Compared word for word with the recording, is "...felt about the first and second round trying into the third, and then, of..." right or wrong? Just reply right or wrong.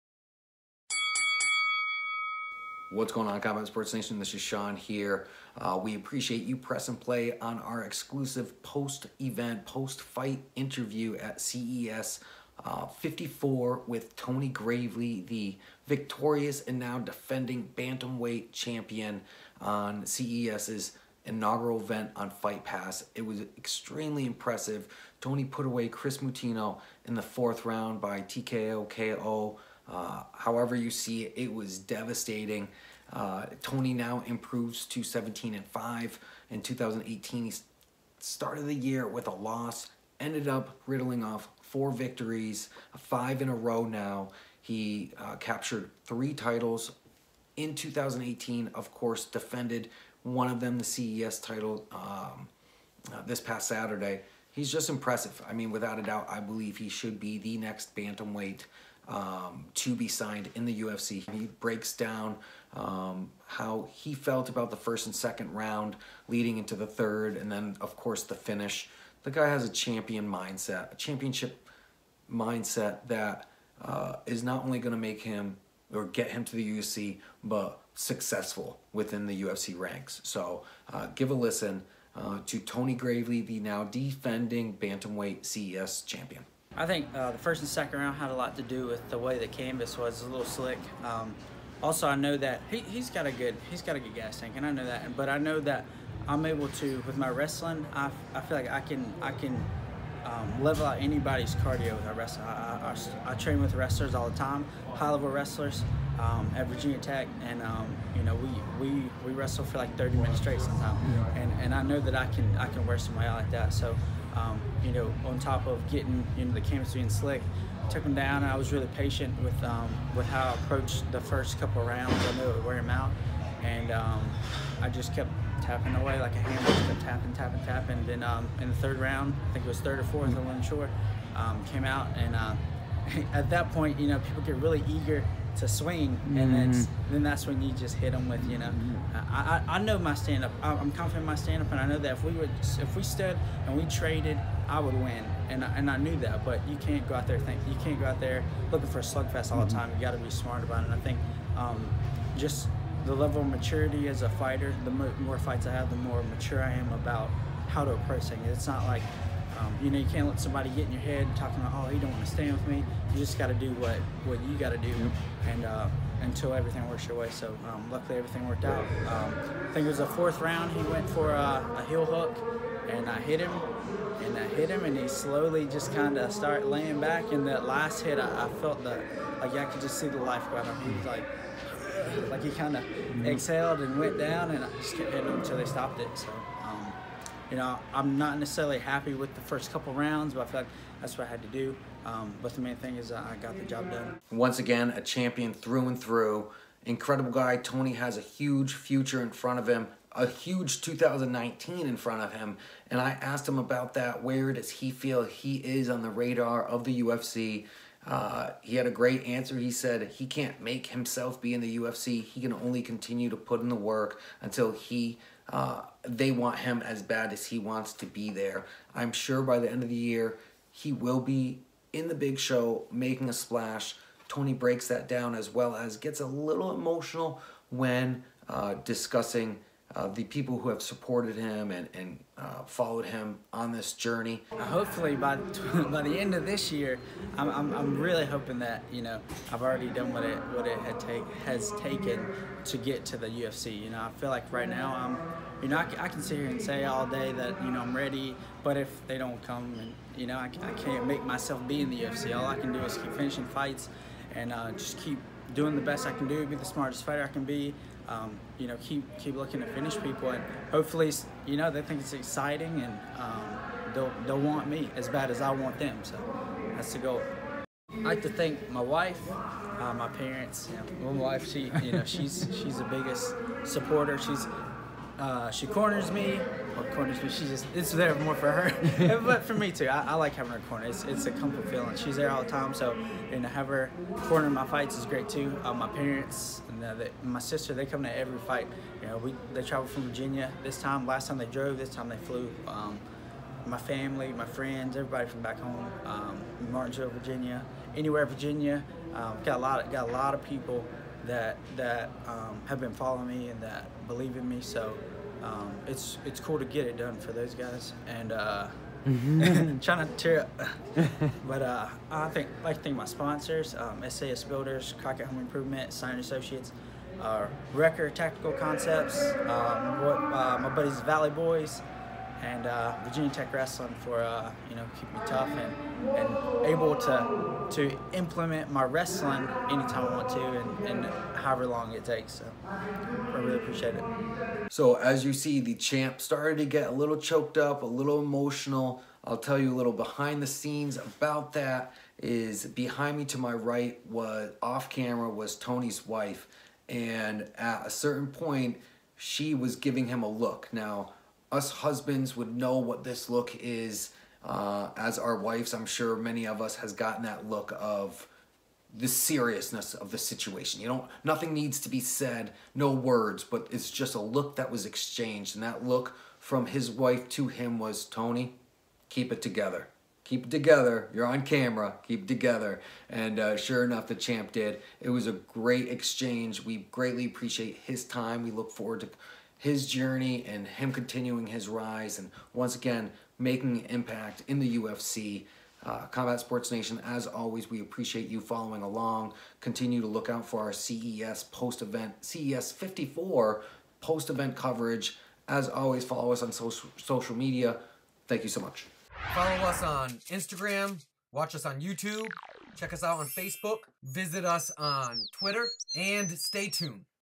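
wrong.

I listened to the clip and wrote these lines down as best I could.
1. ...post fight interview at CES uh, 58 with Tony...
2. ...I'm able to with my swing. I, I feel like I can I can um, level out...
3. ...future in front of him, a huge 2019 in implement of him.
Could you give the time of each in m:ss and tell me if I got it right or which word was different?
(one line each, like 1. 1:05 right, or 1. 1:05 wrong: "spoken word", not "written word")
1. 0:09 wrong: "54", not "58"
2. 1:36 wrong: "wrestling", not "swing"
3. 3:18 wrong: "front", not "implement".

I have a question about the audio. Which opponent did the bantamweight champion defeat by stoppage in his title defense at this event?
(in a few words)
Chris Mutino.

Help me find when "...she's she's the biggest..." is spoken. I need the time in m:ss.
4:32.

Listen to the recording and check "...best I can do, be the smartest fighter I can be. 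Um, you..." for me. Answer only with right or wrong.
right.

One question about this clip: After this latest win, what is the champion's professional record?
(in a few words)
17-5.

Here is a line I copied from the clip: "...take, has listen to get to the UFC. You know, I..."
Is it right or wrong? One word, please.
wrong.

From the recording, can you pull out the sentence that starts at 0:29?
Uh, however you see it, it was devastating.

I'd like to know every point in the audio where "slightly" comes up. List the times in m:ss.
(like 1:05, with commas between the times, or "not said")
not said.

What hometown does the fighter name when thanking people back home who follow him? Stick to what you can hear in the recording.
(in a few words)
Martinsville, Virginia.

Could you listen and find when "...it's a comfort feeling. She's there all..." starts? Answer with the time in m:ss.
4:41.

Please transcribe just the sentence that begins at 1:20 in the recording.
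So uh, give a listen uh, to Tony Gravely, the now defending bantamweight CES champion.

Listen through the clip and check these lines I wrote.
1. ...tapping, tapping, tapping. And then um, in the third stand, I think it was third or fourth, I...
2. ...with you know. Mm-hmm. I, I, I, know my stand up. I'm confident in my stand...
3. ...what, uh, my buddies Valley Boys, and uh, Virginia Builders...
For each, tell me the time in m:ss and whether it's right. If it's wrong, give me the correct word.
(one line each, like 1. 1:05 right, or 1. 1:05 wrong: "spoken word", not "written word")
1. 2:07 wrong: "round", not "stand"
2. 2:18 right
3. 5:20 wrong: "Tech", not "Builders".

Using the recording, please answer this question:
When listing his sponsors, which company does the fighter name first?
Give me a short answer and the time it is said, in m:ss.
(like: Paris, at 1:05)
SAS Builders, at 5:14.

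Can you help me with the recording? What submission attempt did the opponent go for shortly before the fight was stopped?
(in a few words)
Heel hook.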